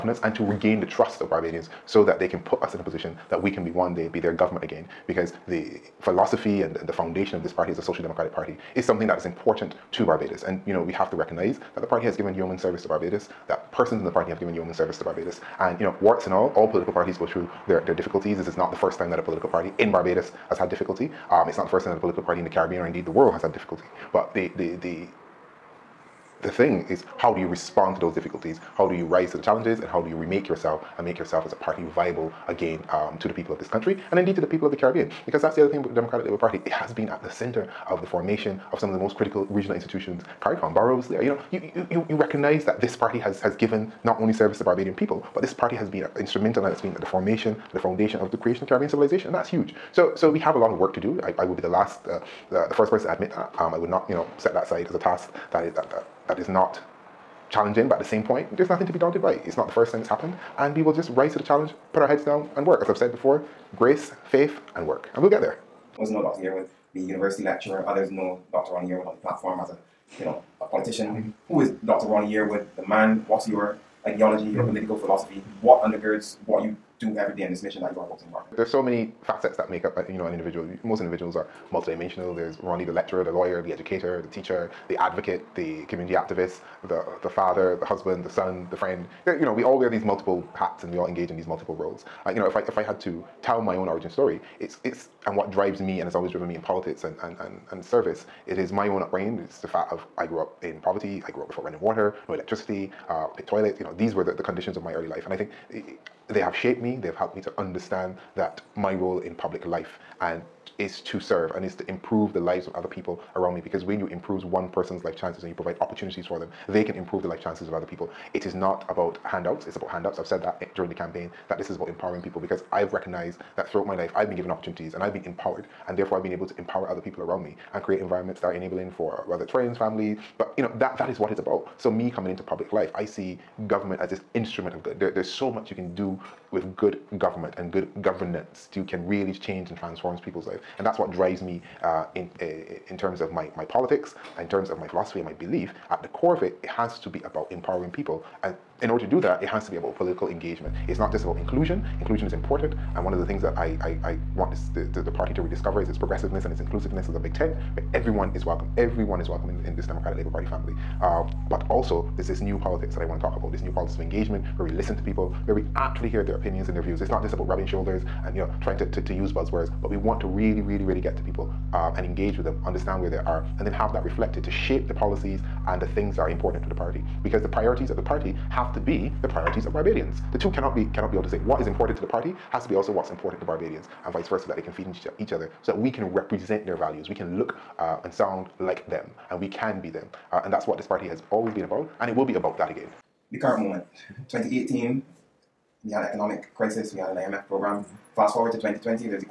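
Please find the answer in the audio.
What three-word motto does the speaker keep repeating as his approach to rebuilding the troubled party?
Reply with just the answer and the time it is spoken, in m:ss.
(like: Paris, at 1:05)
grace, faith, and work, at 1:03.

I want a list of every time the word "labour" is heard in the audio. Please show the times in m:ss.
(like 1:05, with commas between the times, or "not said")
0:36, 2:40.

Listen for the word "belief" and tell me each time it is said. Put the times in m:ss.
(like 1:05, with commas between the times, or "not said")
2:25.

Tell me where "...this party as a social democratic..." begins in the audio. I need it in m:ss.
0:07.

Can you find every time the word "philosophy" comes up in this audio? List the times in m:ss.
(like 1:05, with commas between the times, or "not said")
0:06, 1:14, 2:24.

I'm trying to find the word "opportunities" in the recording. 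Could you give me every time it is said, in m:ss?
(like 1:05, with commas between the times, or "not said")
1:55, 2:04.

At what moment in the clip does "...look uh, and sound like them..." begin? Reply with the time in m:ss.
3:07.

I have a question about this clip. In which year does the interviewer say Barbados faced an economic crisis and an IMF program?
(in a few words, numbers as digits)
2018.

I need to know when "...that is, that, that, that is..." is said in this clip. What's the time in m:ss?
0:55.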